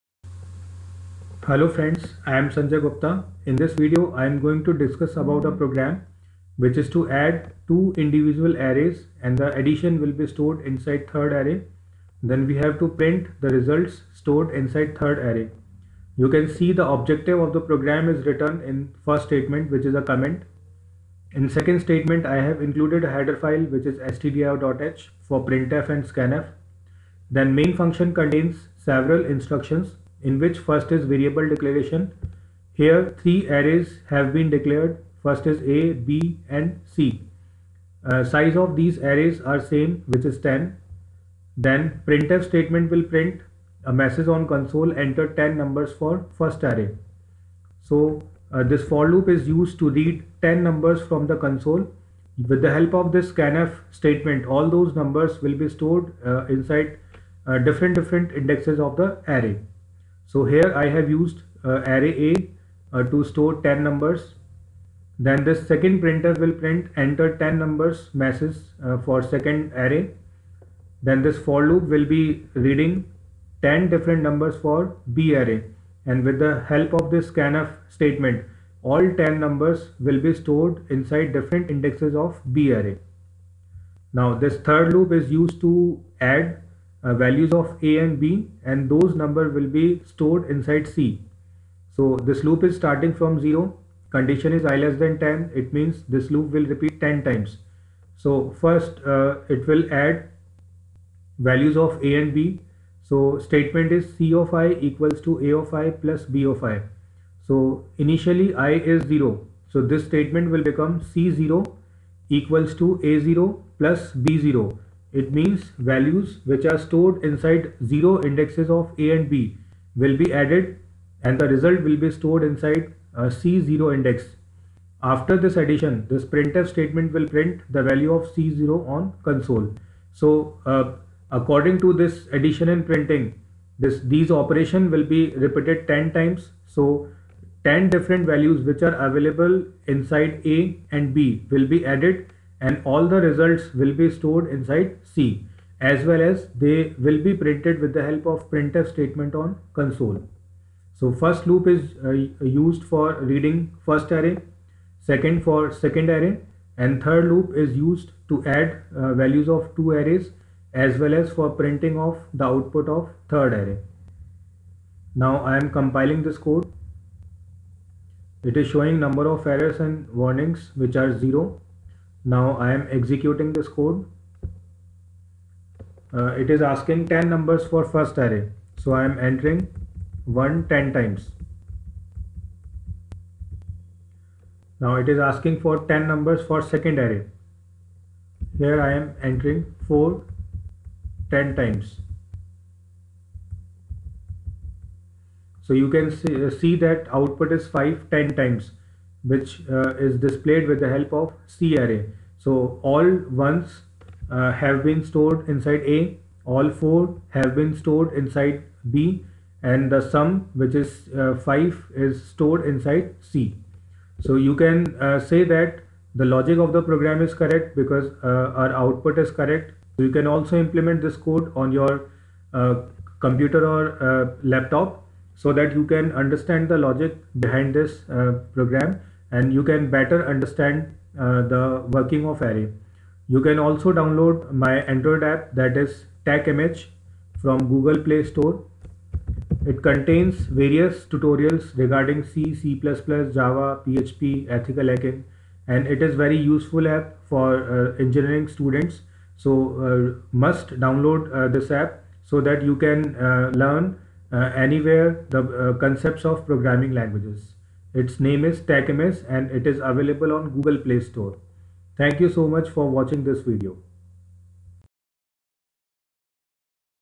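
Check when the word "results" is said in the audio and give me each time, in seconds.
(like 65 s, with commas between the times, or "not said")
13 s, 121 s, 143 s.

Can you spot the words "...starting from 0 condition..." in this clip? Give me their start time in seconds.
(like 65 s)
92 s.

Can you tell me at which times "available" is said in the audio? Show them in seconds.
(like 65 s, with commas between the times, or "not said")
139 s, 259 s.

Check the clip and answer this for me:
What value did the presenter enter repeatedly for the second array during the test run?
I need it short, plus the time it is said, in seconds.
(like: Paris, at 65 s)
4, at 189 s.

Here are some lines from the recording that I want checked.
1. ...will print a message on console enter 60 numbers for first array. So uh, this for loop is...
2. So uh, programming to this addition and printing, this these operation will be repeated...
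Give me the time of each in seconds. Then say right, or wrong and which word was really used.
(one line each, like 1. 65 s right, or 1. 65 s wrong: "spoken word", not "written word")
1. 42 s wrong: "10", not "60"
2. 130 s wrong: "according", not "programming".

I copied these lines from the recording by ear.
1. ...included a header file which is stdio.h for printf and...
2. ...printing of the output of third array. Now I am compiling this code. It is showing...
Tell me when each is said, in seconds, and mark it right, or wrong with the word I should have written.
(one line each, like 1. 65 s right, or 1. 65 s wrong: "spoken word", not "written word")
1. 22 s right
2. 161 s right.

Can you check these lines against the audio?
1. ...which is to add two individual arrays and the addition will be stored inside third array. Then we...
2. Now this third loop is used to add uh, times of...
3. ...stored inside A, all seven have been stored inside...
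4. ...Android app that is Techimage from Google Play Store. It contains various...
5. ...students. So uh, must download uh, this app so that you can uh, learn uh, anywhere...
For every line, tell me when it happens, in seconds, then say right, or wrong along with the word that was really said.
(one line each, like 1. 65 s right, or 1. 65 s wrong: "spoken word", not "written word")
1. 6 s right
2. 84 s wrong: "values", not "times"
3. 205 s wrong: "four", not "seven"
4. 234 s right
5. 248 s right.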